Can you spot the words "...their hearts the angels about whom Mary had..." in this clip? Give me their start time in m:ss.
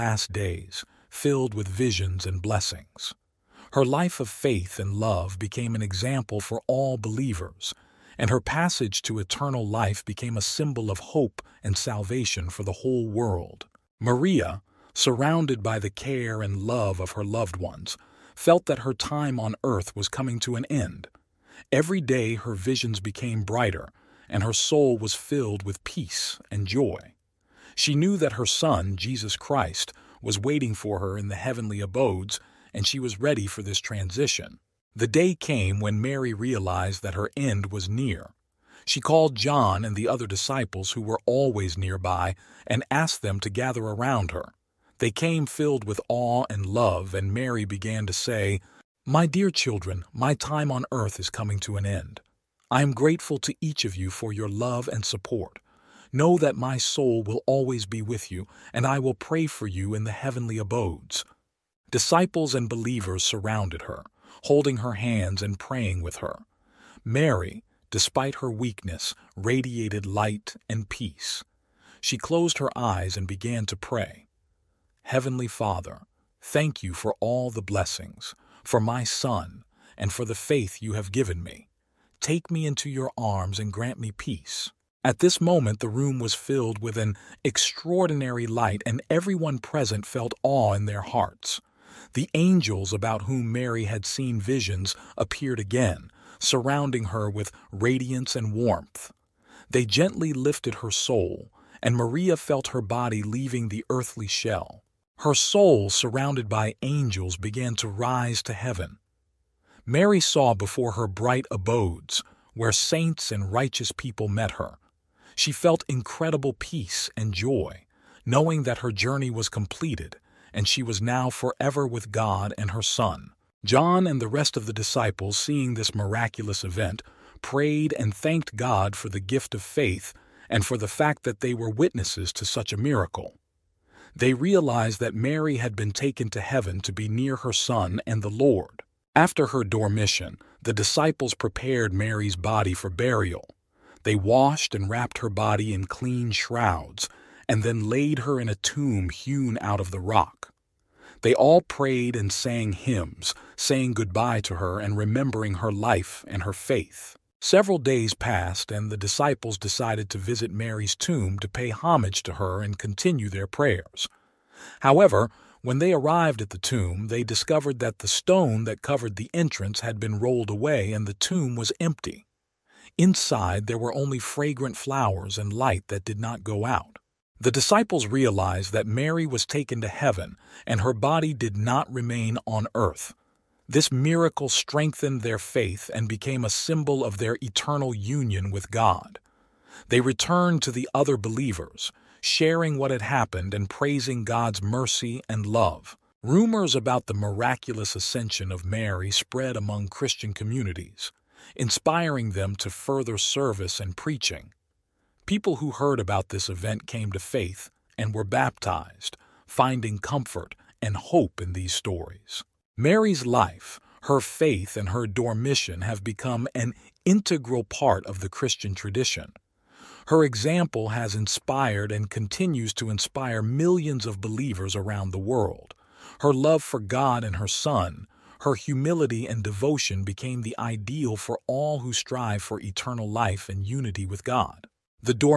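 1:30.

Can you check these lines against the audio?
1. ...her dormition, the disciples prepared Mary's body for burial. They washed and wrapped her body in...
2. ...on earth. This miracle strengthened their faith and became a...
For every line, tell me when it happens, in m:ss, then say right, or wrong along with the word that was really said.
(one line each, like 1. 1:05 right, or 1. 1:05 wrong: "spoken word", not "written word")
1. 2:19 right
2. 3:02 right.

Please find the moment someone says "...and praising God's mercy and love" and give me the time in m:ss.
3:13.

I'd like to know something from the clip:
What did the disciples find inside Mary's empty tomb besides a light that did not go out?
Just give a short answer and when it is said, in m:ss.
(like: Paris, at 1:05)
Fragrant flowers, at 2:54.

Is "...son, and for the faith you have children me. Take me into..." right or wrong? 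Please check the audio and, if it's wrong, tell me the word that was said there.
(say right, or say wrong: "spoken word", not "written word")
wrong: "given", not "children".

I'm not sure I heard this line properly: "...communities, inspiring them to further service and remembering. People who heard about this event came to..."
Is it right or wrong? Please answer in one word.
wrong.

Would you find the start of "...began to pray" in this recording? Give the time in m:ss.
1:13.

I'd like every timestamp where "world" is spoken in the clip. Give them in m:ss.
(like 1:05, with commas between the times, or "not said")
0:13, 3:45.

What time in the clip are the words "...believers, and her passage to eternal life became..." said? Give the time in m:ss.
0:06.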